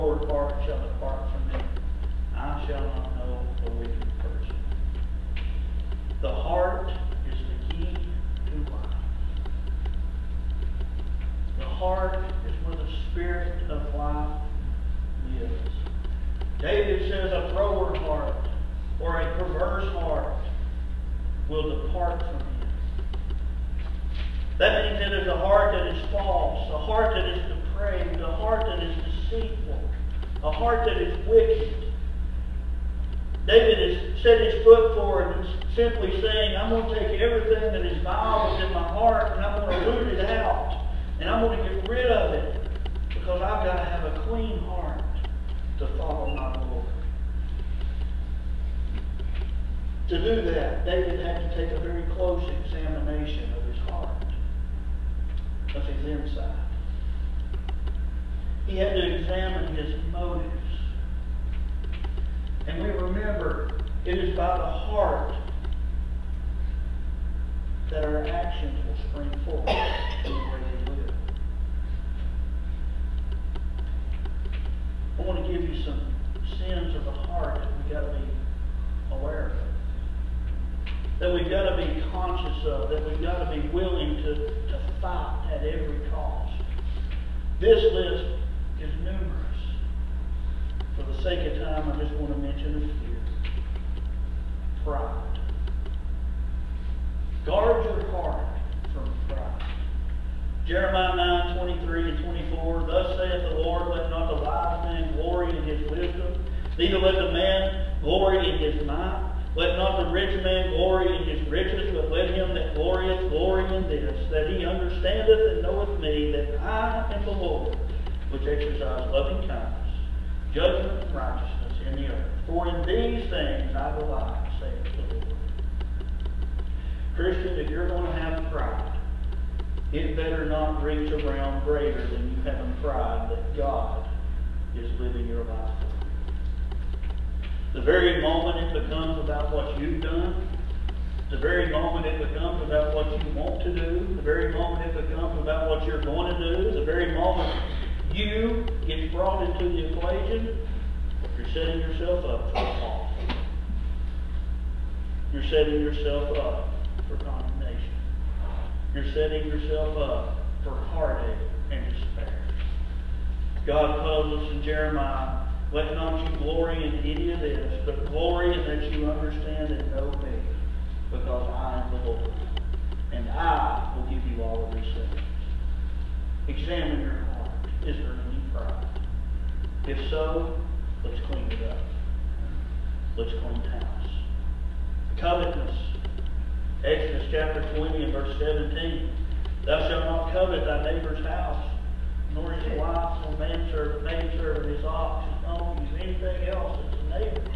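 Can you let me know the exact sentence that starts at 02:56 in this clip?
Examine your heart is earthly pride?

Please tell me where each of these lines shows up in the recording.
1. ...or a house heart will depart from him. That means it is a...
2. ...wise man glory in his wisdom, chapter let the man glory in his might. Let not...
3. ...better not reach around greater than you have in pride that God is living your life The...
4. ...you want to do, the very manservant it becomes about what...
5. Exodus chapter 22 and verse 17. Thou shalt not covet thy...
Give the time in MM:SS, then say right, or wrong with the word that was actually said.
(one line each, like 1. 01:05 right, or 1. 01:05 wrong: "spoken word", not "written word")
1. 00:19 wrong: "perverse", not "house"
2. 01:44 wrong: "neither", not "chapter"
3. 02:10 right
4. 02:23 wrong: "moment", not "manservant"
5. 03:06 wrong: "20", not "22".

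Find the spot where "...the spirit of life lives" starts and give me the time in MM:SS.
00:12.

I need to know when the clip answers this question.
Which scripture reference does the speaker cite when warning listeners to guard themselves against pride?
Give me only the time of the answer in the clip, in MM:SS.
01:40.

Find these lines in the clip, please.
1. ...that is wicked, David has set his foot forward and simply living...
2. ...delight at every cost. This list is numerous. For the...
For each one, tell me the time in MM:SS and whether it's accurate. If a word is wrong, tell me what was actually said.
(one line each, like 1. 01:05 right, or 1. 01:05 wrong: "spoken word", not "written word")
1. 00:30 wrong: "saying", not "living"
2. 01:25 wrong: "fight", not "delight".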